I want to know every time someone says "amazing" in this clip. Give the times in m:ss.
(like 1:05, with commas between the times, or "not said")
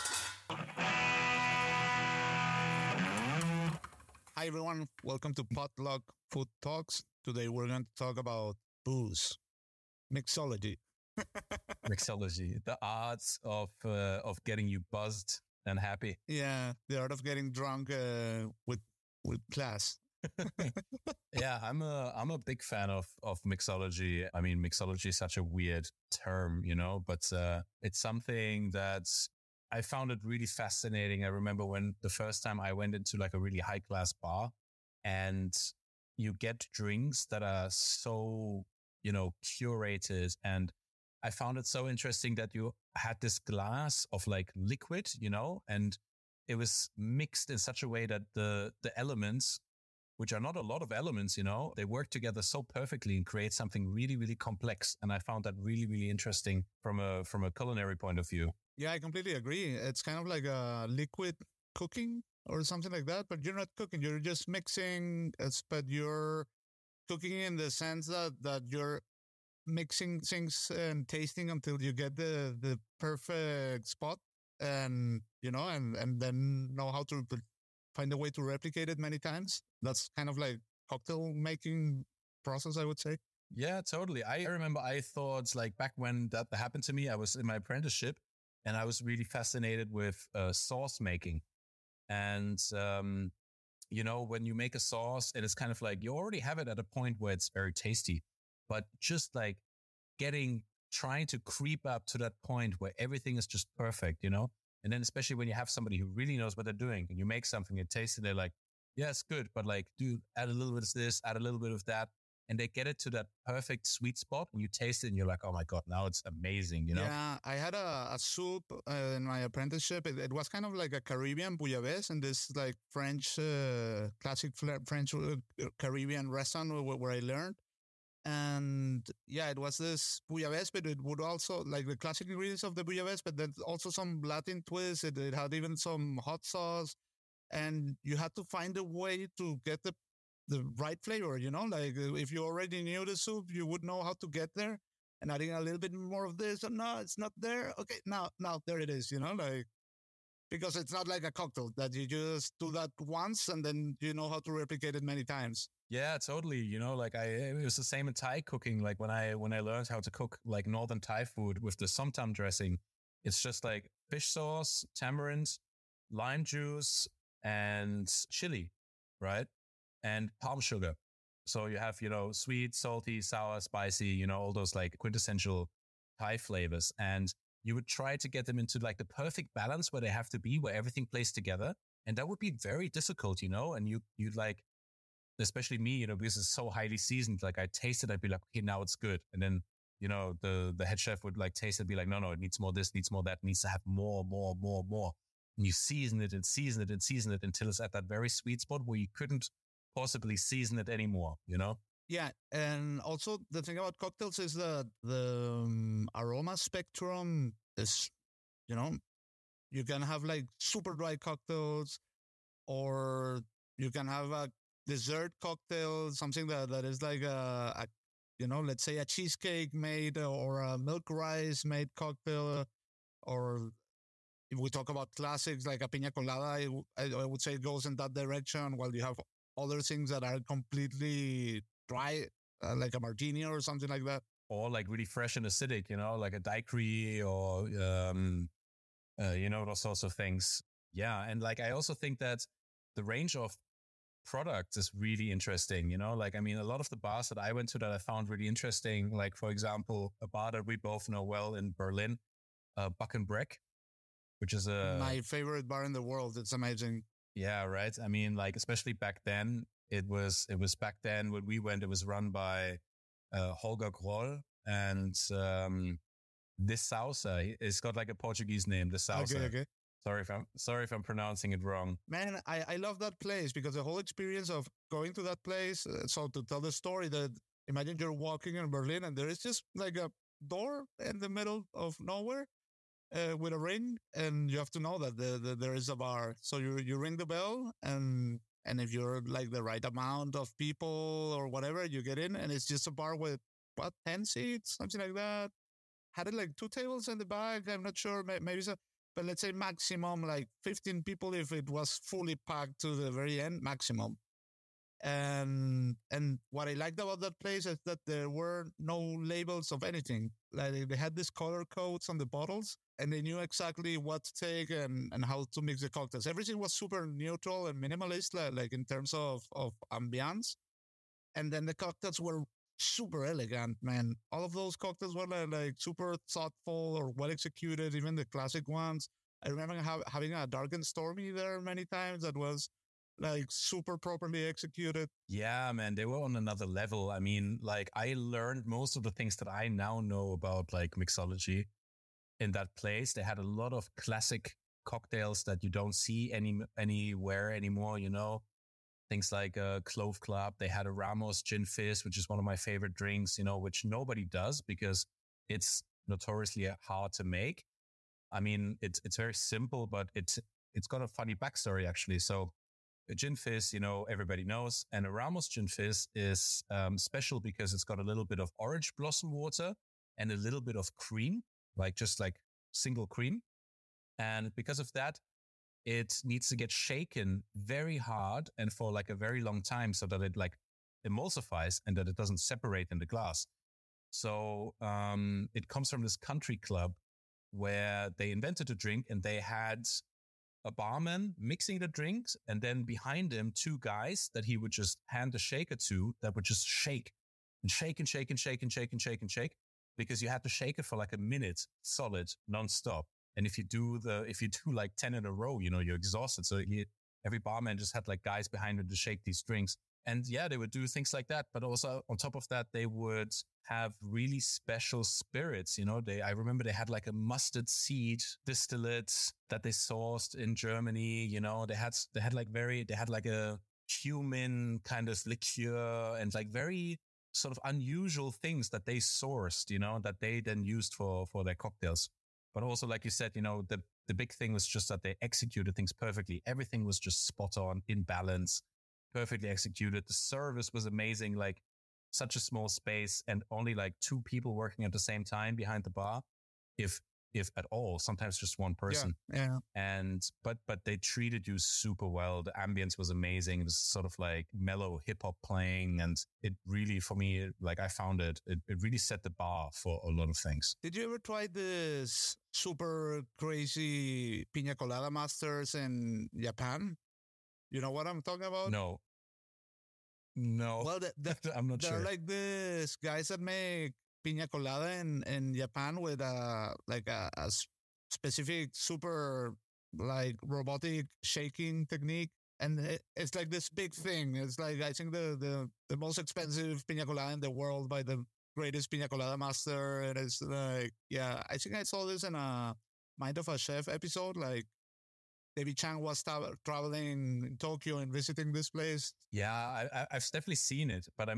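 1:56, 4:16, 7:20, 7:33.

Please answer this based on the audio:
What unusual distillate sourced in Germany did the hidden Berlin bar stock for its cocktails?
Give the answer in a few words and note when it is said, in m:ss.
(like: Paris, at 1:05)
mustard seed distillate, at 6:57.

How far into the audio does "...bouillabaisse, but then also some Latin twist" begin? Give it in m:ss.
2:12.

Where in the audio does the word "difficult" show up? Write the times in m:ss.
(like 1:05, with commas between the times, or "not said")
3:02.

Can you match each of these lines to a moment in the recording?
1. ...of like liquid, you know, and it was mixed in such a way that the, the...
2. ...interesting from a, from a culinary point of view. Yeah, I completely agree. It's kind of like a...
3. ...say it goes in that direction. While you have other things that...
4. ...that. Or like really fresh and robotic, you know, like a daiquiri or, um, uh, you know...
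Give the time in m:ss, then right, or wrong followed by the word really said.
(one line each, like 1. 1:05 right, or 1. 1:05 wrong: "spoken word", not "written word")
1. 0:44 right
2. 0:56 right
3. 3:47 right
4. 3:54 wrong: "acidic", not "robotic".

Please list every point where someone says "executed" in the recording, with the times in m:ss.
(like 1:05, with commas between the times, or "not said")
5:27, 5:34, 7:15, 7:19.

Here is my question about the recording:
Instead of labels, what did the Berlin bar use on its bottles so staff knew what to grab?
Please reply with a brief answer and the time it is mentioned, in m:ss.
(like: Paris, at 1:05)
color codes, at 5:11.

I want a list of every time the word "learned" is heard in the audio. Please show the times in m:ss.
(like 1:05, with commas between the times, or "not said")
2:07, 2:39, 5:38.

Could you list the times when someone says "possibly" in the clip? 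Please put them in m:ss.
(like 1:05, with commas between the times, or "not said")
3:19.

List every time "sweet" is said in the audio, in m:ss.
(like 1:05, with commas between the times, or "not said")
1:53, 2:52, 3:18.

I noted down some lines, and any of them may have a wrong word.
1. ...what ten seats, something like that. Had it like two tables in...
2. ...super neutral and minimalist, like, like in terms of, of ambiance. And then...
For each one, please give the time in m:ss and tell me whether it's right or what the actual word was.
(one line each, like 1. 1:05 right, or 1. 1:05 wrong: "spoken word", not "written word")
1. 4:53 right
2. 5:16 right.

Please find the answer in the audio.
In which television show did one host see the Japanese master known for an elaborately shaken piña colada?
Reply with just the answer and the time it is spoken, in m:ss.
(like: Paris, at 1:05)
Mind of a Chef, at 8:13.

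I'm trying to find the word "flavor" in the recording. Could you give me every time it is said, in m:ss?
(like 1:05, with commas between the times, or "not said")
2:21, 2:56.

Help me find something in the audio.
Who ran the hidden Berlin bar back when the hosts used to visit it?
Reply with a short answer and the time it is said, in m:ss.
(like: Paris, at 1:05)
Holger Kroll, at 4:23.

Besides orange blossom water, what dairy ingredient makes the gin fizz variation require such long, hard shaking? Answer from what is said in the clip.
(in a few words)
single cream.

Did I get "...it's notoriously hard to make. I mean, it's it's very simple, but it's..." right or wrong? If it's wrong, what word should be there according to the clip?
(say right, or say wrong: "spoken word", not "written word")
right.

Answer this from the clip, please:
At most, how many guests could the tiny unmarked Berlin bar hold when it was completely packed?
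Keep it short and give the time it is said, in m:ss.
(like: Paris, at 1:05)
15, at 5:00.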